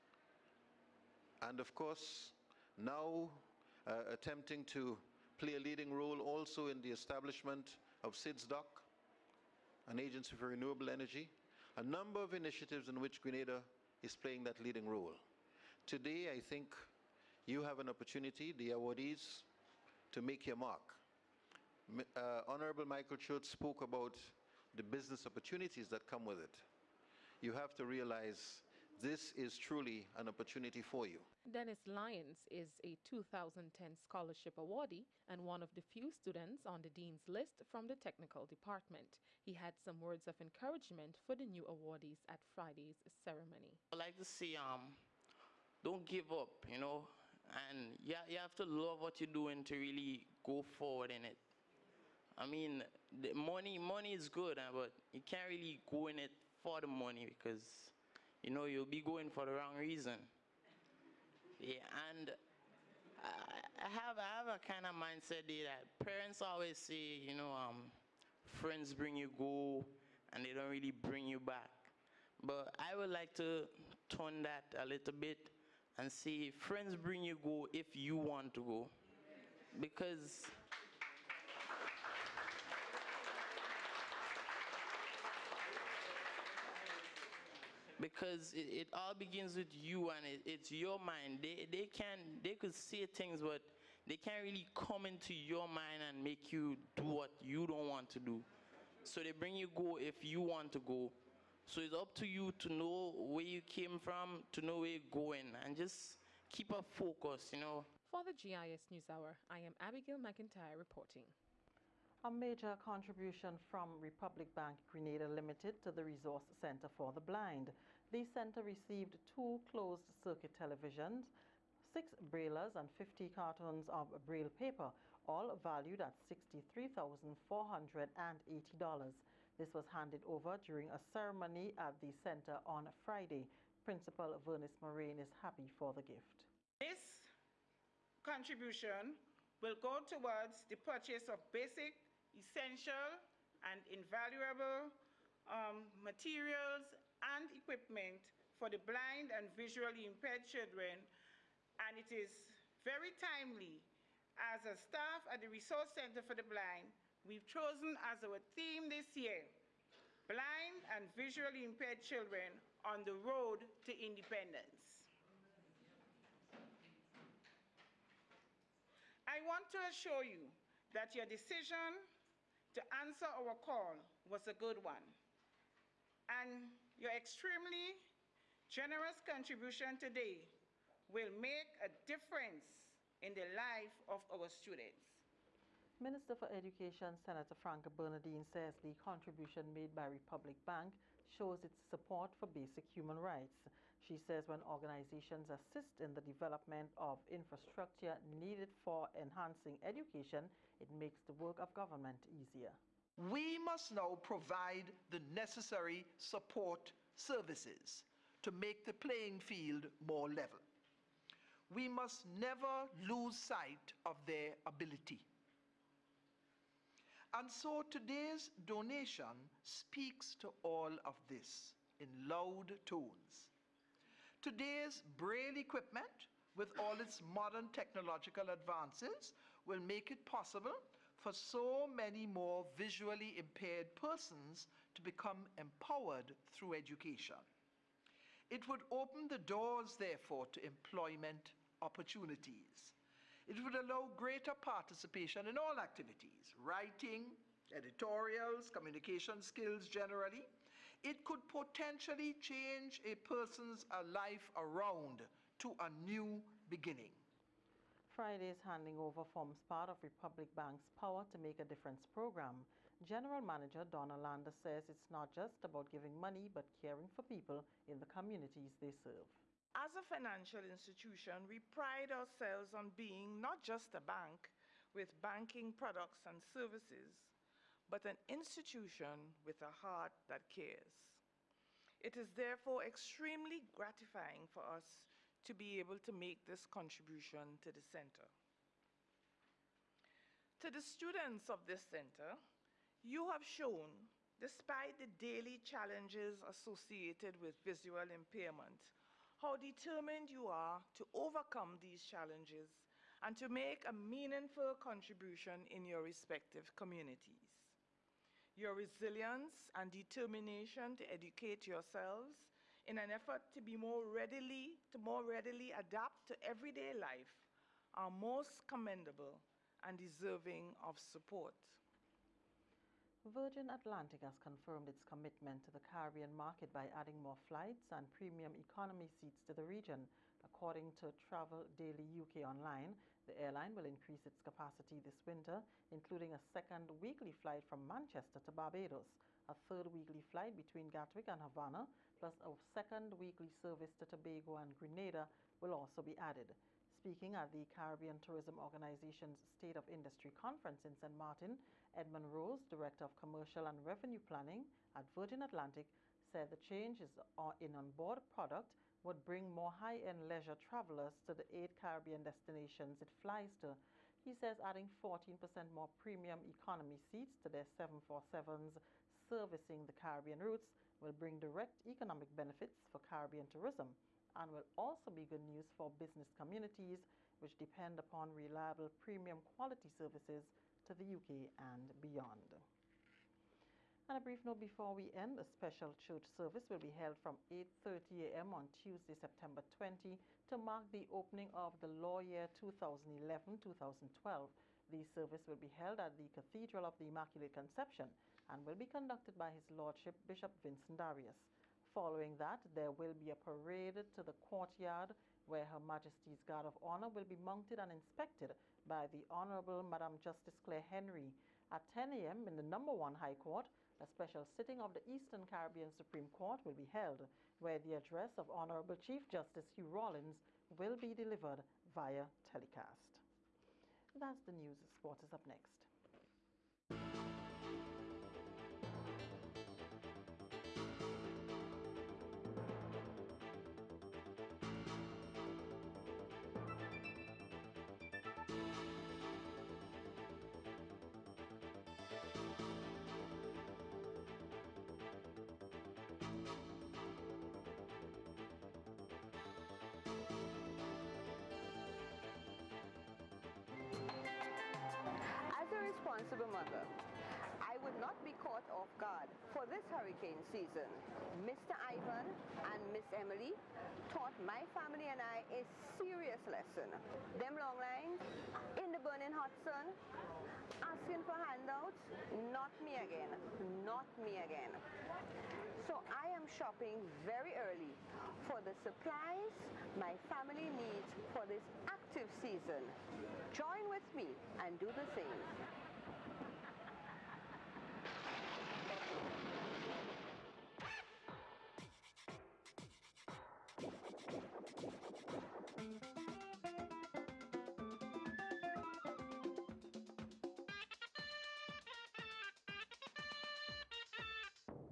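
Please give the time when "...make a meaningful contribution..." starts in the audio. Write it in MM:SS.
05:03.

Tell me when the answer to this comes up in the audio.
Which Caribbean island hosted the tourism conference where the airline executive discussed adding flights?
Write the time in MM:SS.
05:50.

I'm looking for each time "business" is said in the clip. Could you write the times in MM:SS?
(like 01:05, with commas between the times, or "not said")
00:24, 06:15.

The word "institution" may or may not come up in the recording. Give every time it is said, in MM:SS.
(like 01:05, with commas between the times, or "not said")
04:30, 04:38.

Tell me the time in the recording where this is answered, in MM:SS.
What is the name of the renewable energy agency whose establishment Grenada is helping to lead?
00:08.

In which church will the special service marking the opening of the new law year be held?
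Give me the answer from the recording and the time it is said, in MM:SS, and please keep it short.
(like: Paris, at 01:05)
Cathedral of the Immaculate Conception, at 06:36.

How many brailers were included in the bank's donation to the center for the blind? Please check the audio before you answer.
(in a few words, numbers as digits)
6.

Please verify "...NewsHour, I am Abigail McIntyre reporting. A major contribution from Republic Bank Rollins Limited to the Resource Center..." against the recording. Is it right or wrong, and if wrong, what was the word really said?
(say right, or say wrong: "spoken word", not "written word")
wrong: "Grenada", not "Rollins".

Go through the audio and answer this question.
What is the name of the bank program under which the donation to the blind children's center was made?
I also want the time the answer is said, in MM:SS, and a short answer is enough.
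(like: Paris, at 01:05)
Power to Make a Difference, at 04:20.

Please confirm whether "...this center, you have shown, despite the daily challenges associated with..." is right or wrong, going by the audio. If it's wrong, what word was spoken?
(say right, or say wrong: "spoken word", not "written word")
right.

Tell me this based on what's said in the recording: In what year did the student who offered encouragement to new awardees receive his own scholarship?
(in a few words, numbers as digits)
2010.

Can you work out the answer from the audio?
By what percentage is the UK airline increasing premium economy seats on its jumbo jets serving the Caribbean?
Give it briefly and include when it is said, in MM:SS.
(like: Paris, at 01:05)
14%, at 06:04.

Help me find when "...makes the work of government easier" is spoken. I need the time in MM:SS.
03:20.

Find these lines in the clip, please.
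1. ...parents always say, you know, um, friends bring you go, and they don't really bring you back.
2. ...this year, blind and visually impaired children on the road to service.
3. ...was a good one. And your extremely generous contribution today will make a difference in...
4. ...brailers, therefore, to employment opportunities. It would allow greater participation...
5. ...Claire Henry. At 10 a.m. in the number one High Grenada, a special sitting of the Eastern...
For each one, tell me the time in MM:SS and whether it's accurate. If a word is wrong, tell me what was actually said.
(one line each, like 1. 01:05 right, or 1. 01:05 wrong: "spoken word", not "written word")
1. 01:05 right
2. 02:38 wrong: "independence", not "service"
3. 02:54 right
4. 03:59 wrong: "doors", not "brailers"
5. 06:50 wrong: "Court", not "Grenada".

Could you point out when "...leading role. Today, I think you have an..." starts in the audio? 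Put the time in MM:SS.
00:14.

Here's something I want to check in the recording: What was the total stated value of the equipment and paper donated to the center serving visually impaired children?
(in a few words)
$63,480.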